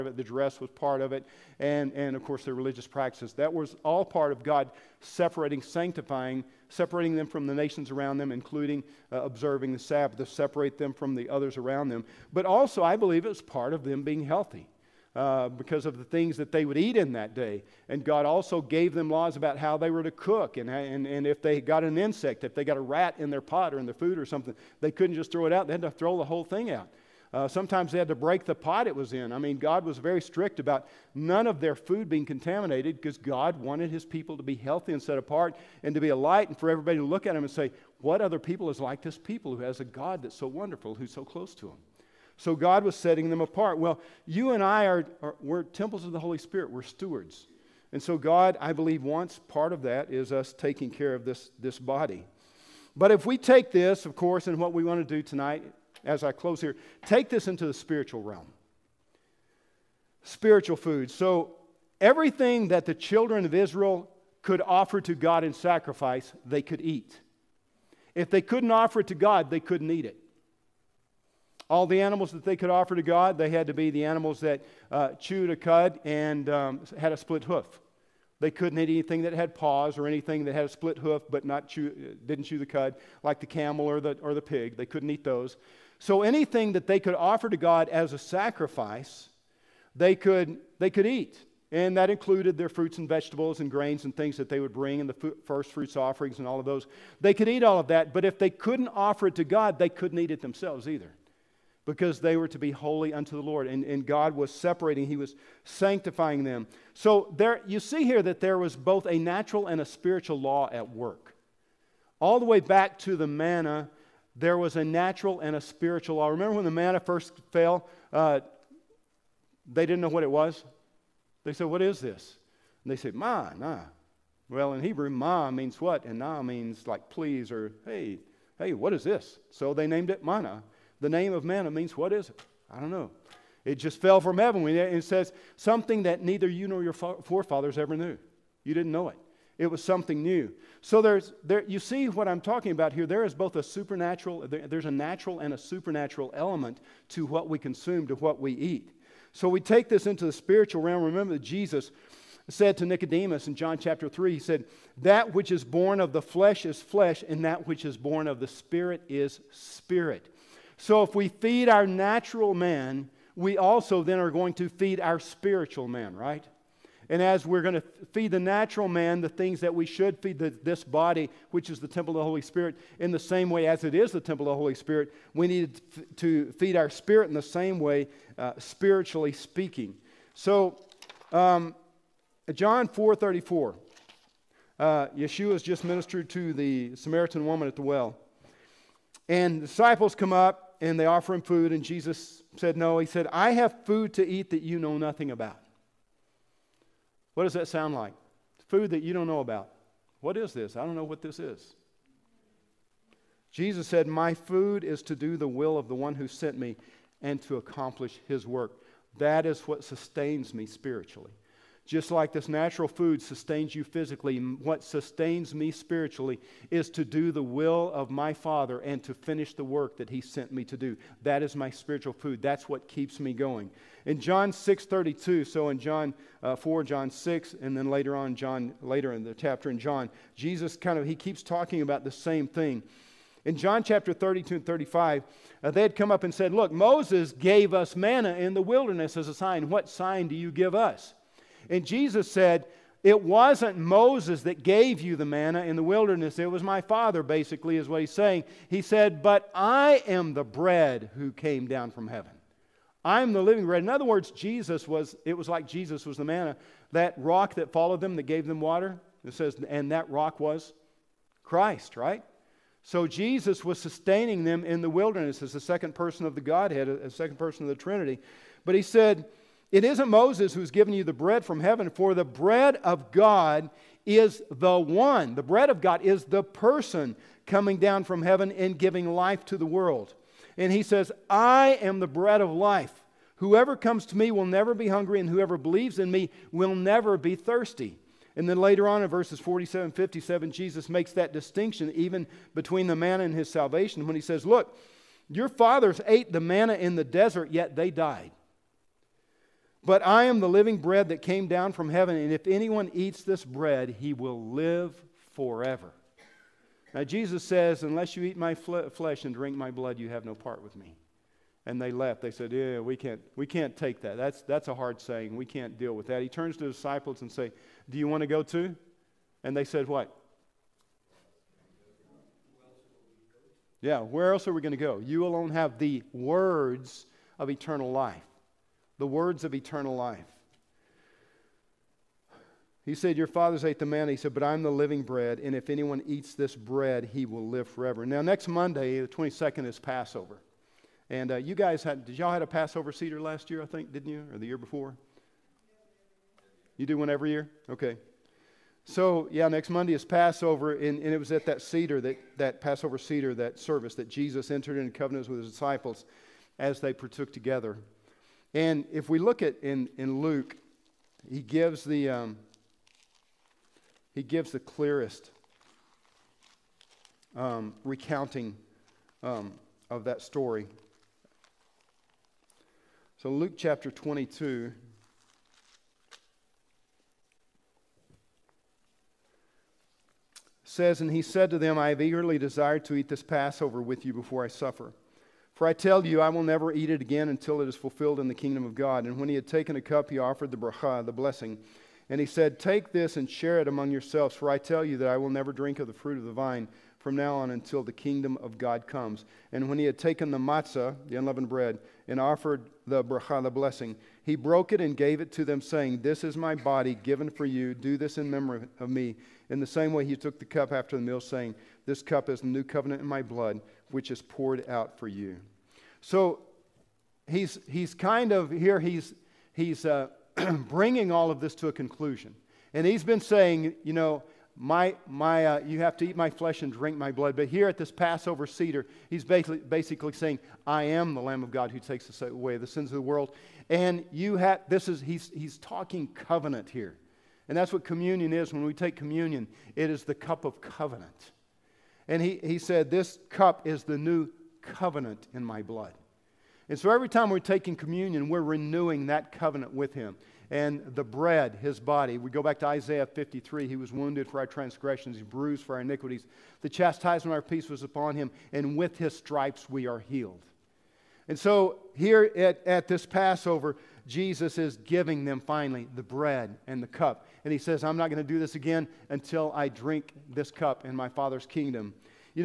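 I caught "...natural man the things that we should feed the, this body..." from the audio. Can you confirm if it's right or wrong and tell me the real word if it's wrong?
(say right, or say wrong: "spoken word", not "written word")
right.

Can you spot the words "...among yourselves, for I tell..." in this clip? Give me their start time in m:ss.
6:33.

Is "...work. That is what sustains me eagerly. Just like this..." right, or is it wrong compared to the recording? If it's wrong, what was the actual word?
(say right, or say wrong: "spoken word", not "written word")
wrong: "spiritually", not "eagerly".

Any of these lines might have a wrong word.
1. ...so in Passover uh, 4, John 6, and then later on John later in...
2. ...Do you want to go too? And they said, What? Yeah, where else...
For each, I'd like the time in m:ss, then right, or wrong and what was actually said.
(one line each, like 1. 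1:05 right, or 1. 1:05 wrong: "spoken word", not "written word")
1. 3:45 wrong: "John", not "Passover"
2. 5:17 right.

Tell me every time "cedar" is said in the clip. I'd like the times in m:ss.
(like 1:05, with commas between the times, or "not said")
7:08.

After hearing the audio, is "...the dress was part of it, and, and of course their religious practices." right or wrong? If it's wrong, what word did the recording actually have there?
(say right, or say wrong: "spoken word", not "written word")
right.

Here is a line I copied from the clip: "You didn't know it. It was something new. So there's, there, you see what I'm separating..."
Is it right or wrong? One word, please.
wrong.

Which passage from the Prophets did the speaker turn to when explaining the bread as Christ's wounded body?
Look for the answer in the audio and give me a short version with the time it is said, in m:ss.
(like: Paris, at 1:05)
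Isaiah 53, at 7:32.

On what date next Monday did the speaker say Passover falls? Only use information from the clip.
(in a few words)
The 22nd.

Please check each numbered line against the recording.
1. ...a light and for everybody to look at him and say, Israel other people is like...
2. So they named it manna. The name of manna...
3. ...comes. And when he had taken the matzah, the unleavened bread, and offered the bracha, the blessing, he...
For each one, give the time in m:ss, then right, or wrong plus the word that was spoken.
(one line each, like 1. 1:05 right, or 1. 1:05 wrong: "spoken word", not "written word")
1. 0:36 wrong: "What", not "Israel"
2. 2:09 right
3. 6:38 right.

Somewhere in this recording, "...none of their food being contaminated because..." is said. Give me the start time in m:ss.
0:31.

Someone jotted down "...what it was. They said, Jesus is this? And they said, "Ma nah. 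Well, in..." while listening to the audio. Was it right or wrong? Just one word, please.
wrong.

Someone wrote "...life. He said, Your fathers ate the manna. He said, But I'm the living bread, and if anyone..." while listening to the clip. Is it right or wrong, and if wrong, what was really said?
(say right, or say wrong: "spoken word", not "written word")
right.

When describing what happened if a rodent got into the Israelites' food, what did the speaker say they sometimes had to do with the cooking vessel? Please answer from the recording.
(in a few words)
Break the pot.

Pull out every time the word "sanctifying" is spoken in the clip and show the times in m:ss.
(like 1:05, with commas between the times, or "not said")
0:05, 1:45.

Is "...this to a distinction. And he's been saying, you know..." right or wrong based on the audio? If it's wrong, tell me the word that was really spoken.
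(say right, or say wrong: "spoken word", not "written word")
wrong: "conclusion", not "distinction".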